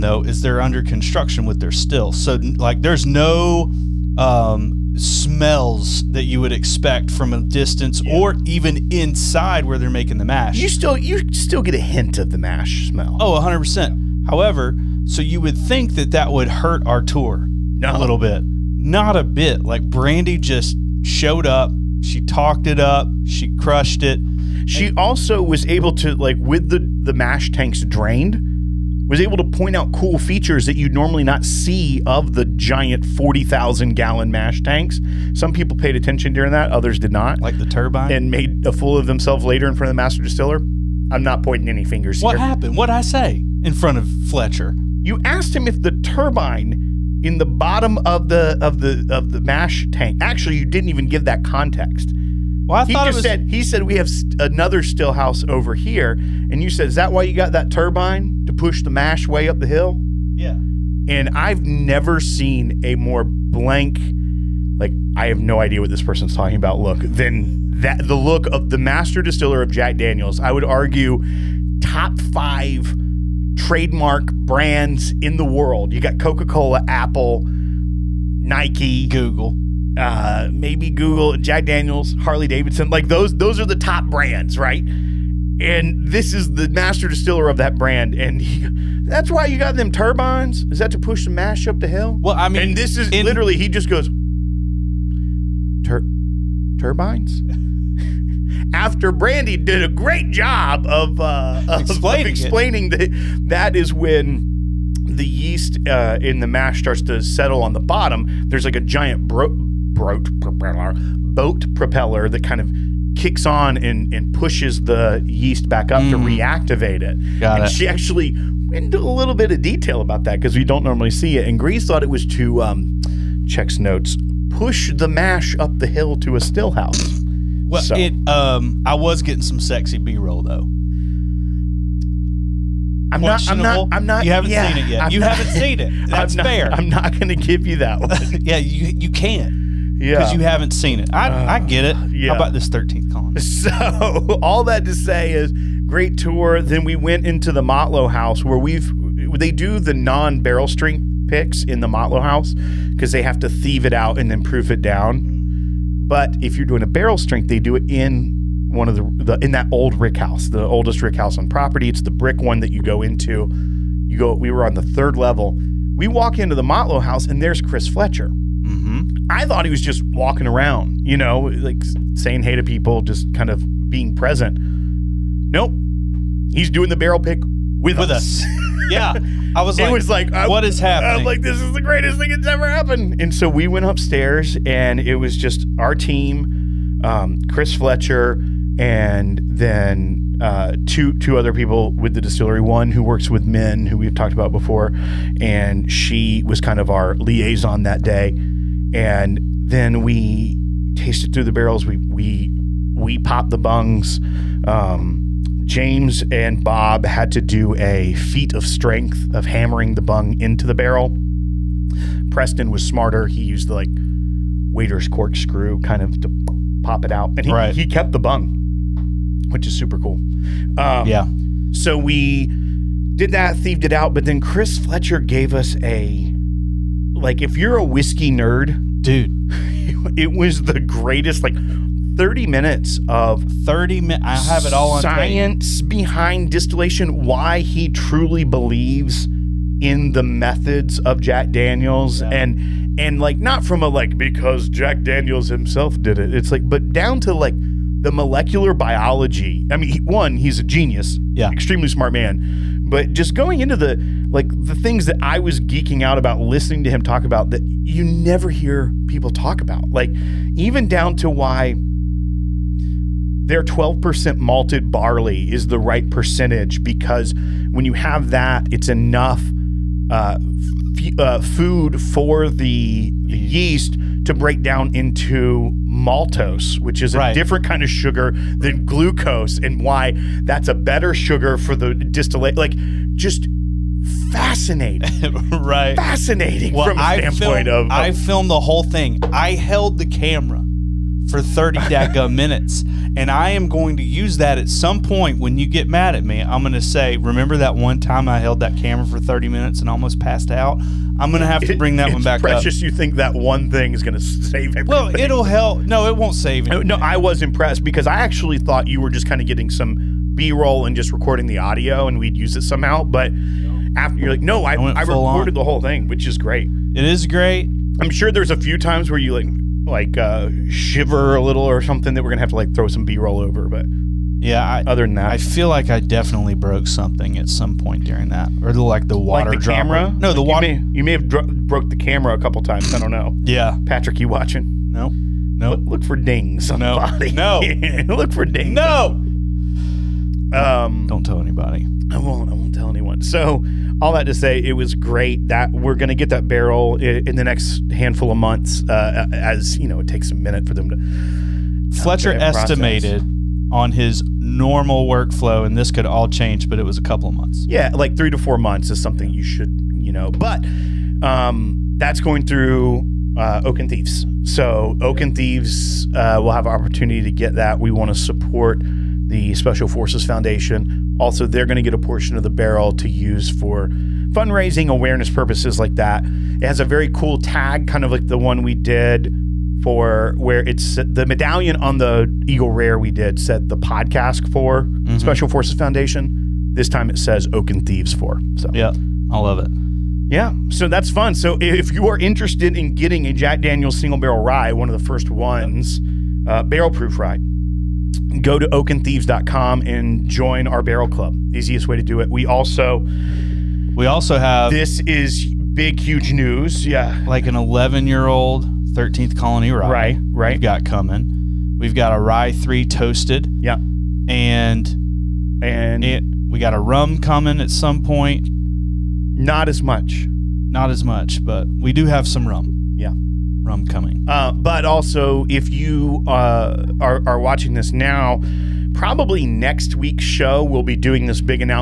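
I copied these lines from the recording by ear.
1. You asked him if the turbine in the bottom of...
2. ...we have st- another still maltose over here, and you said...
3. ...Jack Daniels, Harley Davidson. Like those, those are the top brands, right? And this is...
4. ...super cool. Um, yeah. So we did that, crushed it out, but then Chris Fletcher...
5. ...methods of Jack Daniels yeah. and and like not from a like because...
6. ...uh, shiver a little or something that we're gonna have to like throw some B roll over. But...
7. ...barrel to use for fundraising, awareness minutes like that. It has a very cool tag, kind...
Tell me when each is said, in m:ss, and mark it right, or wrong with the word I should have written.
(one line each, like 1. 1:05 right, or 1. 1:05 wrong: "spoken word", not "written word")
1. 0:45 right
2. 0:53 wrong: "house", not "maltose"
3. 1:21 right
4. 3:39 wrong: "thieved", not "crushed"
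5. 4:00 right
6. 5:20 right
7. 6:12 wrong: "purposes", not "minutes".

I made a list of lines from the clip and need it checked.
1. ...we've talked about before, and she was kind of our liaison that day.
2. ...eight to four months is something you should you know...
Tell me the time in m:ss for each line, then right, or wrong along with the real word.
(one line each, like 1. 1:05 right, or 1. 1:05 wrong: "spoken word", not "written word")
1. 3:13 right
2. 5:58 wrong: "three", not "eight".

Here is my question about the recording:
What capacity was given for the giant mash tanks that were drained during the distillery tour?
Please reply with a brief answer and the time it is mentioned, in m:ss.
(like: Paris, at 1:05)
40,000 gallons, at 0:33.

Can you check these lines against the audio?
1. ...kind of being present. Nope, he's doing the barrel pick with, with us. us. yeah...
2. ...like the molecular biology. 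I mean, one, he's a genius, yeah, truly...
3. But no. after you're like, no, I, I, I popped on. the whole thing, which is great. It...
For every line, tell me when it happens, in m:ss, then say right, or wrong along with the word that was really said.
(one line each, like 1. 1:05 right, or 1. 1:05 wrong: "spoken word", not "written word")
1. 2:53 right
2. 4:07 wrong: "extremely", not "truly"
3. 5:13 wrong: "recorded", not "popped".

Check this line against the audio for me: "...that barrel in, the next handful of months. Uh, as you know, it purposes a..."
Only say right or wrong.
wrong.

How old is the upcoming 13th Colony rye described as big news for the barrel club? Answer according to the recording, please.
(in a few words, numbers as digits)
11 years.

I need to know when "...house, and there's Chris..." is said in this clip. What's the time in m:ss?
2:47.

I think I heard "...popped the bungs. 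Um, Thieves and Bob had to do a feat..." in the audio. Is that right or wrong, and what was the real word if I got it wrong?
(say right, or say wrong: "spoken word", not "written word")
wrong: "James", not "Thieves".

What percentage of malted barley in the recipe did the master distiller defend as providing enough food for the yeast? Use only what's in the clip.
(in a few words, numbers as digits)
12%.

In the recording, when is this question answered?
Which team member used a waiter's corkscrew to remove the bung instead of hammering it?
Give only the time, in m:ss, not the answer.
3:32.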